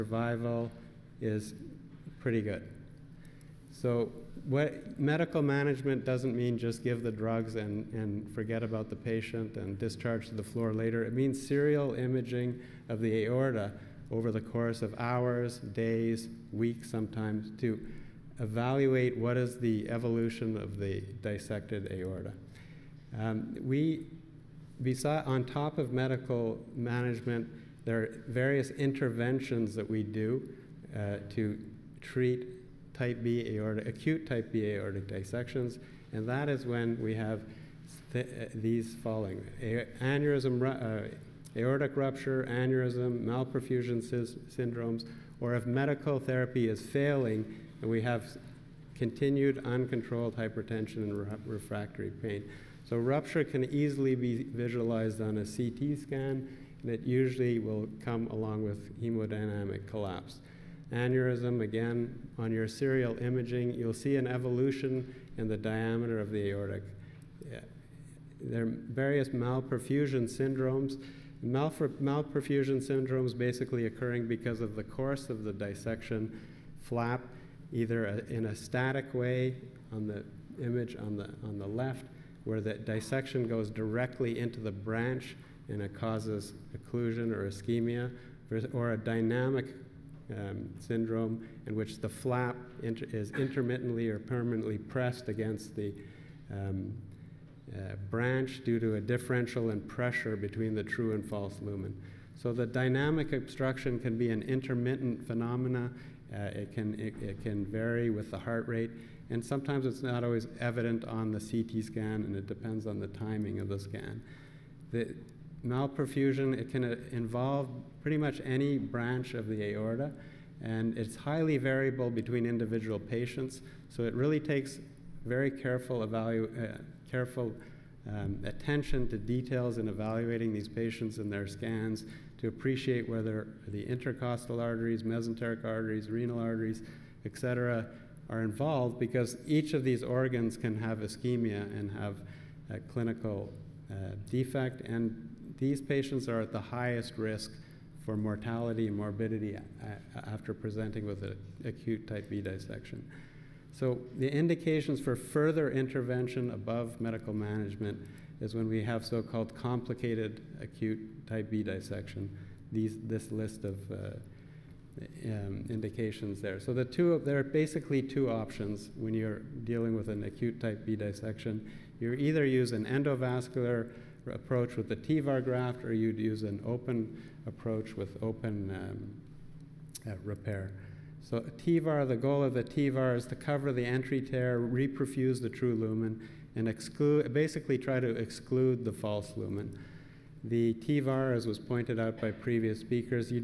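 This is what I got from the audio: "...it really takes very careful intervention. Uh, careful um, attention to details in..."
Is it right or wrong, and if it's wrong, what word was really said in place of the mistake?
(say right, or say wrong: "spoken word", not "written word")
wrong: "evaluation", not "intervention".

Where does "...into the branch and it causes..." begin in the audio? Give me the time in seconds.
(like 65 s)
84 s.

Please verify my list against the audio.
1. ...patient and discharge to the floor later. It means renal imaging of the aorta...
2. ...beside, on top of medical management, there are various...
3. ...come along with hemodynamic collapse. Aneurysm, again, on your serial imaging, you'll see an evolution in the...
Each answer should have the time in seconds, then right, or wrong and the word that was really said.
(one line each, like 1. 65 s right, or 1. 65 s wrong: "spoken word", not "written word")
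1. 8 s wrong: "serial", not "renal"
2. 24 s right
3. 58 s right.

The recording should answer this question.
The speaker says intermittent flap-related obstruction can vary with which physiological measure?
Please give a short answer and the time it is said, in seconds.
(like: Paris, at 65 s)
Heart rate, at 108 s.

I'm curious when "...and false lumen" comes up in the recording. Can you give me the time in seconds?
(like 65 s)
101 s.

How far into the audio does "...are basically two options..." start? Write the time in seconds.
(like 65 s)
167 s.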